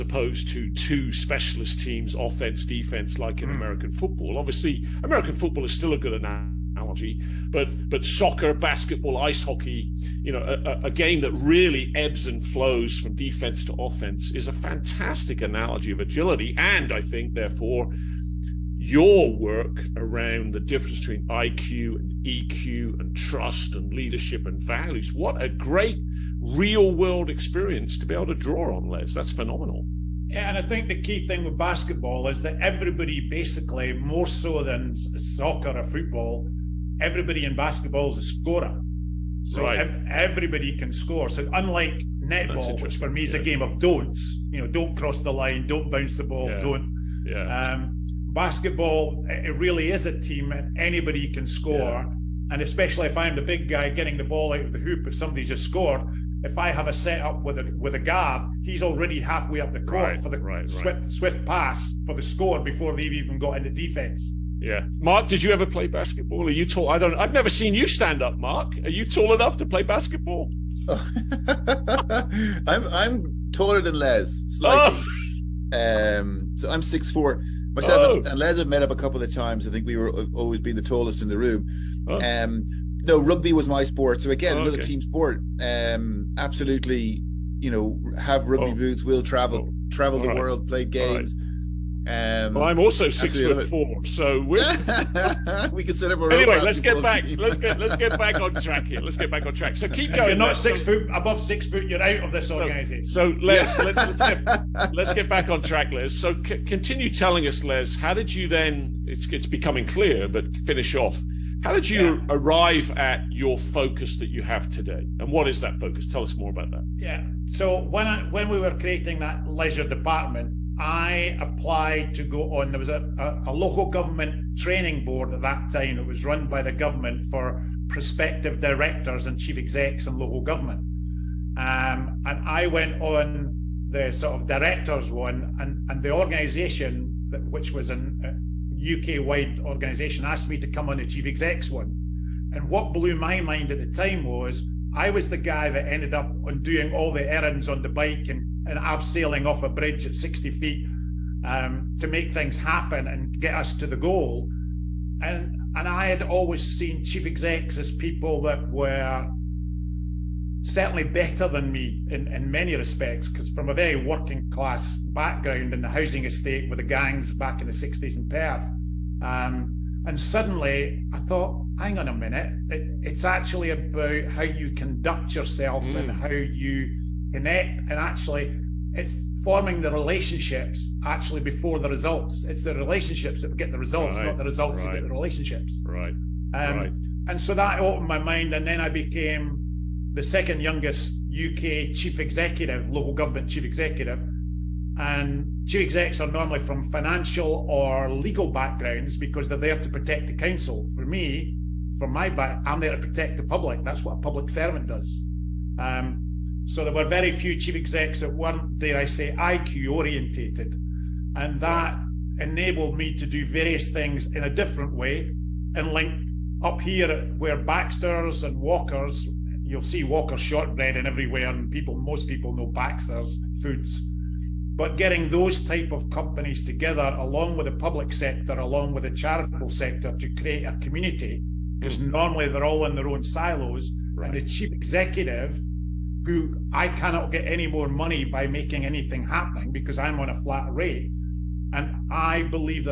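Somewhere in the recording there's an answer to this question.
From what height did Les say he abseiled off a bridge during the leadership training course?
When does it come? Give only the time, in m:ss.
2:30.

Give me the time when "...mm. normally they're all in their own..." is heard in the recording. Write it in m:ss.
3:51.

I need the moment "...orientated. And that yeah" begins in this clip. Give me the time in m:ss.
3:29.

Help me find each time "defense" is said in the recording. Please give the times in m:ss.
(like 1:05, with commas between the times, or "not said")
0:02, 0:13, 1:03.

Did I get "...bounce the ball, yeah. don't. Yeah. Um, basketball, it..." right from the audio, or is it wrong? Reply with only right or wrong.
right.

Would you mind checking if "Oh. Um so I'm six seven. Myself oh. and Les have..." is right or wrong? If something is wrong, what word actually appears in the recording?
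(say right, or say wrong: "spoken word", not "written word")
wrong: "four", not "seven".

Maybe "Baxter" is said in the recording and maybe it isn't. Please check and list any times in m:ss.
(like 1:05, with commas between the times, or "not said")
3:37, 3:42.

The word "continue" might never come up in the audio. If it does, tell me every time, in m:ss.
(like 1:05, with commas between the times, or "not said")
1:46.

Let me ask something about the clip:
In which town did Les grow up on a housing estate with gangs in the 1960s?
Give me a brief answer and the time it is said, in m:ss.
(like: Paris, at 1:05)
Perth, at 2:48.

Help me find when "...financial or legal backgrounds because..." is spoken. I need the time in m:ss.
3:16.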